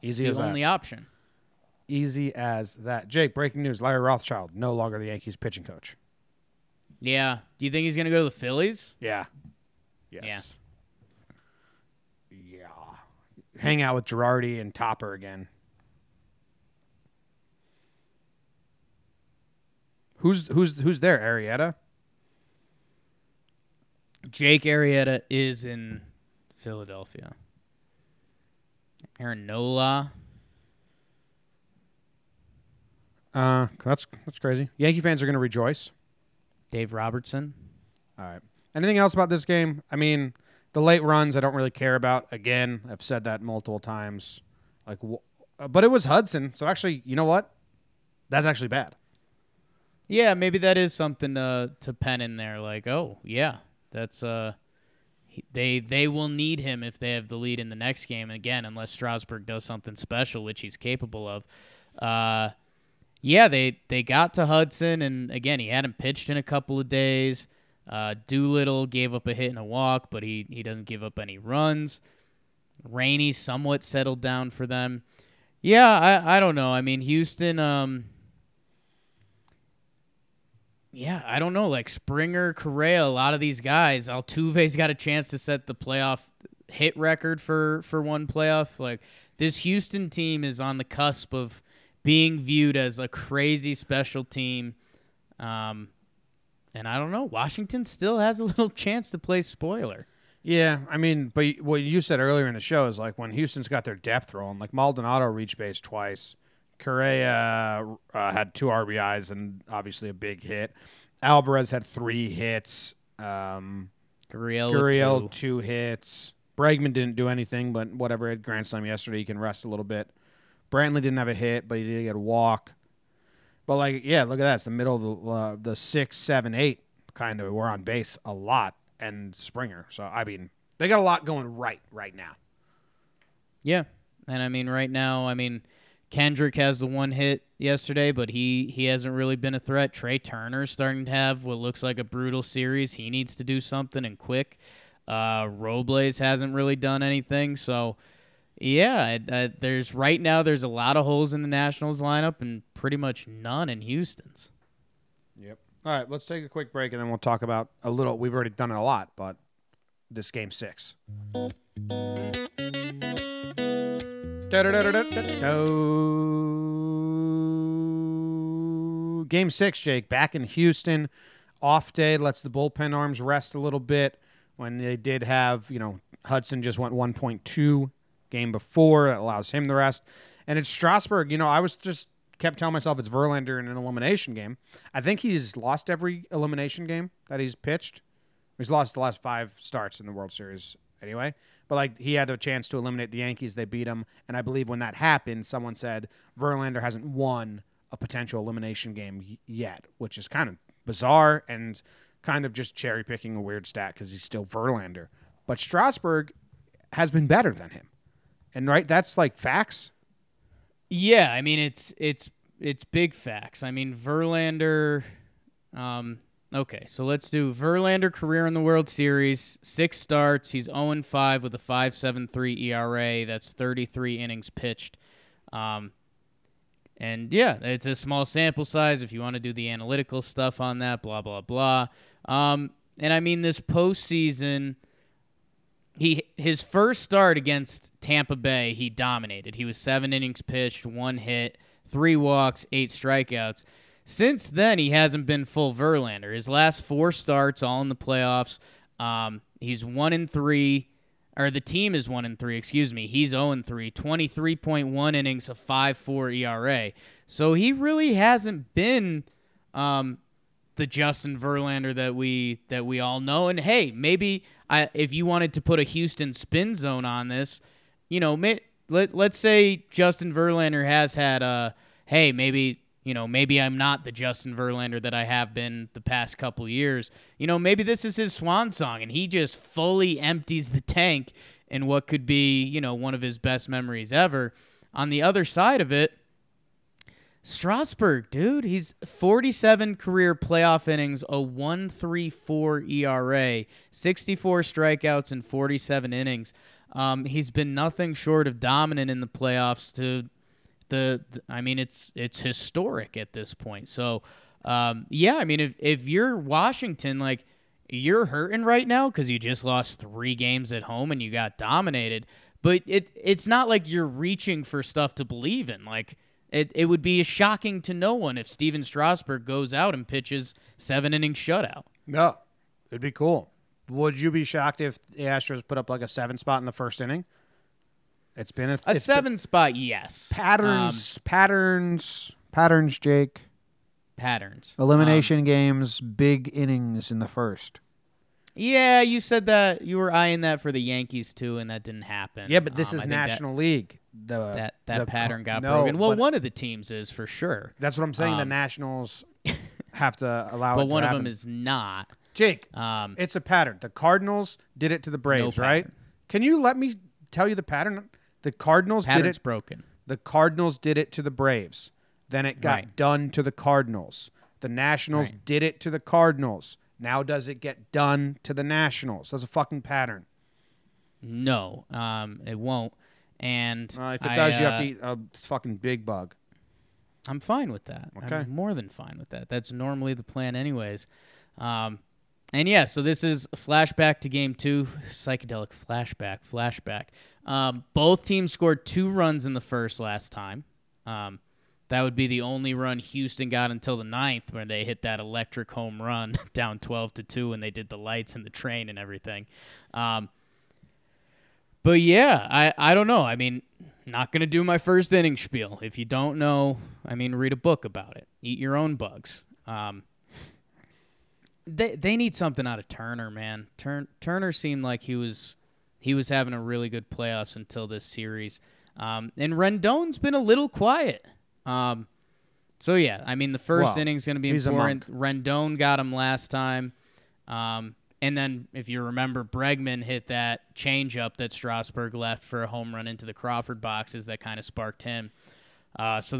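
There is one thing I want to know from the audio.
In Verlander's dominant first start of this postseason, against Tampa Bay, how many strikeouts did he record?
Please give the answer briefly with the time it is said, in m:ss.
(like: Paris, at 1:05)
8, at 4:02.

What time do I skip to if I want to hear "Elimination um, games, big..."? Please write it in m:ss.
5:34.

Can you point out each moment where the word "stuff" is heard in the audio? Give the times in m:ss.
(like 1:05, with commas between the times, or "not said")
3:50, 5:14.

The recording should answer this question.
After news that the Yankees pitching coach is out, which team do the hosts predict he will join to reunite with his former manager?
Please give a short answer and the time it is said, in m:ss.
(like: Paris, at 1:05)
Phillies, at 0:08.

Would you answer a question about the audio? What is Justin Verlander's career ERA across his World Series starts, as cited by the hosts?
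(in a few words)
5.73.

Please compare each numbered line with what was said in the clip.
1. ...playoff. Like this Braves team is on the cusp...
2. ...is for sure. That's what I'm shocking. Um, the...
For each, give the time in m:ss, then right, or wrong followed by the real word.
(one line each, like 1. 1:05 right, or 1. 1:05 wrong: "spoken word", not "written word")
1. 1:28 wrong: "Houston", not "Braves"
2. 5:46 wrong: "saying", not "shocking".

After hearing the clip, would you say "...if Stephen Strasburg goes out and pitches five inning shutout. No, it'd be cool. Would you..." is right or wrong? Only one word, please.
wrong.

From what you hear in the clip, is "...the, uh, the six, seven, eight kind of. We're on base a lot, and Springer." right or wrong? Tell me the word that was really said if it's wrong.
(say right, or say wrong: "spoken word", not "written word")
right.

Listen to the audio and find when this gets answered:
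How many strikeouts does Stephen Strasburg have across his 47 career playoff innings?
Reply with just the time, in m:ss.
4:53.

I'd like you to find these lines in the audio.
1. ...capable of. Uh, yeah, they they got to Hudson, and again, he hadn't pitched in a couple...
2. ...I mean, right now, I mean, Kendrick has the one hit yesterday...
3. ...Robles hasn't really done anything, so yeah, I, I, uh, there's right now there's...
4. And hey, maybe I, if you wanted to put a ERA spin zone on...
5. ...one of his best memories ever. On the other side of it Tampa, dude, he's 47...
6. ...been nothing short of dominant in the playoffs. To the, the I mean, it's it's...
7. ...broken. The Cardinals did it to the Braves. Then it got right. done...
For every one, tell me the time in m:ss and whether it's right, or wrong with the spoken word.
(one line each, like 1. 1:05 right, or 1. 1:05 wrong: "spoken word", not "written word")
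1. 1:00 right
2. 2:14 right
3. 2:25 right
4. 4:23 wrong: "Houston", not "ERA"
5. 4:42 wrong: "Strasburg", not "Tampa"
6. 4:57 right
7. 5:59 right.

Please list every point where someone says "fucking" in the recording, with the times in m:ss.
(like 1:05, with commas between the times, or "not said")
6:09, 6:15.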